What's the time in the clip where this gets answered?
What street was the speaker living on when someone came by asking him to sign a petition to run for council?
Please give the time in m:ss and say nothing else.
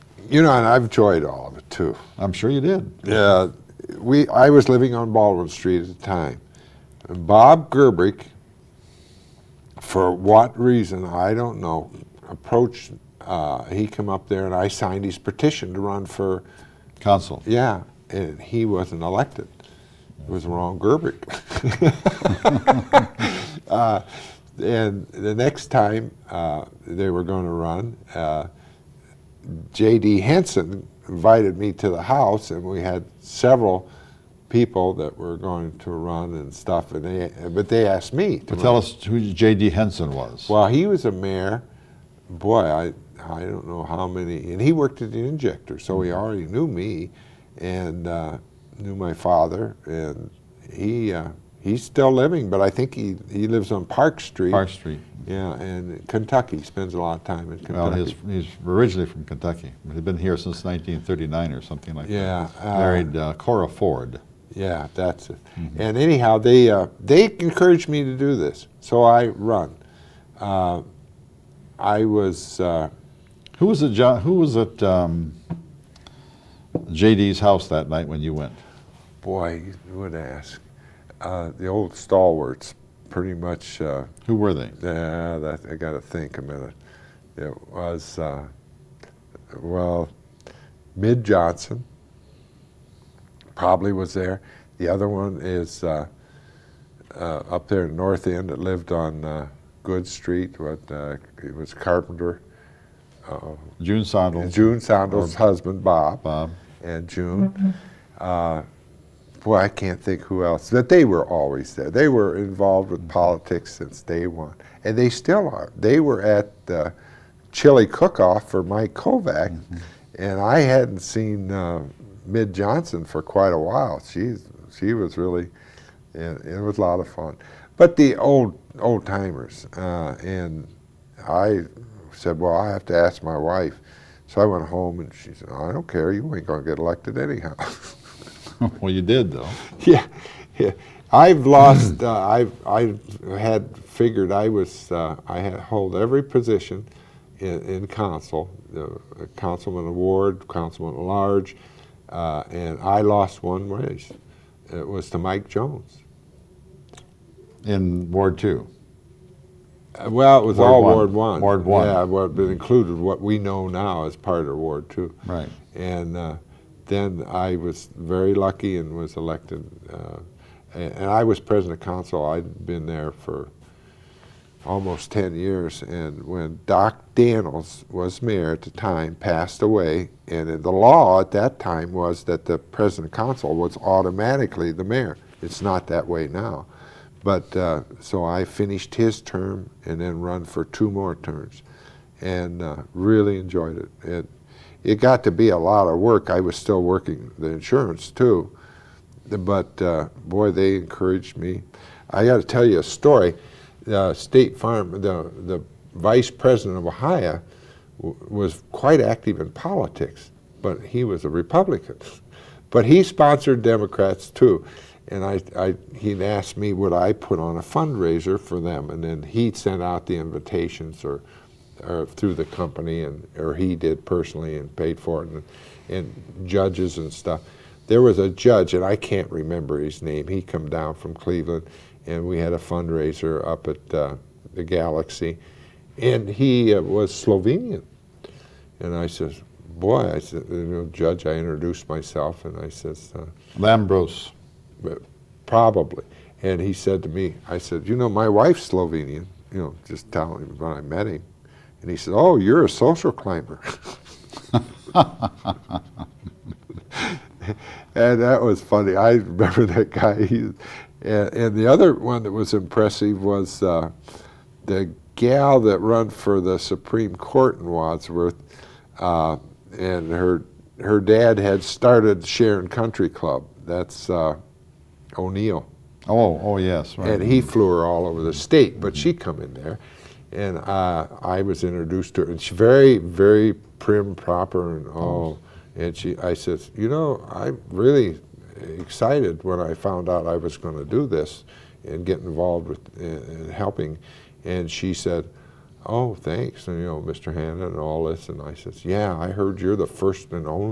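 0:05.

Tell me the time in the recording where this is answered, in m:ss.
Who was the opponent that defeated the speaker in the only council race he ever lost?
2:35.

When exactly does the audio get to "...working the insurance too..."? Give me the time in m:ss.
3:16.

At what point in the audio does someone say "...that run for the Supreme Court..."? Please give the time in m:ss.
4:25.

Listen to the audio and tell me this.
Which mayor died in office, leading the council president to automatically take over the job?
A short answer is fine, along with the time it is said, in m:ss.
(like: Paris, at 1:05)
Doc Daniels, at 2:56.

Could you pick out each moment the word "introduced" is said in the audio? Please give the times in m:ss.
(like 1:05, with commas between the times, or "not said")
4:01, 4:41.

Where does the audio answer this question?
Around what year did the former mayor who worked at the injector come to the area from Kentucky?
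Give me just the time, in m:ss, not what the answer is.
1:00.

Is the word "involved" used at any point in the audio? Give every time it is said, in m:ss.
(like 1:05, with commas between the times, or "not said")
1:52, 4:52.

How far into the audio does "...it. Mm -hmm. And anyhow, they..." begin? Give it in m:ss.
1:05.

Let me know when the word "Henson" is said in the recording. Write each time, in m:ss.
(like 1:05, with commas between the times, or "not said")
0:30, 0:39.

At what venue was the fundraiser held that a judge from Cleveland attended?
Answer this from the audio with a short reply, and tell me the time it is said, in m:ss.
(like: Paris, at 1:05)
the Galaxy, at 3:54.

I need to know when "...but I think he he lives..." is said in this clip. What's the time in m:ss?
0:52.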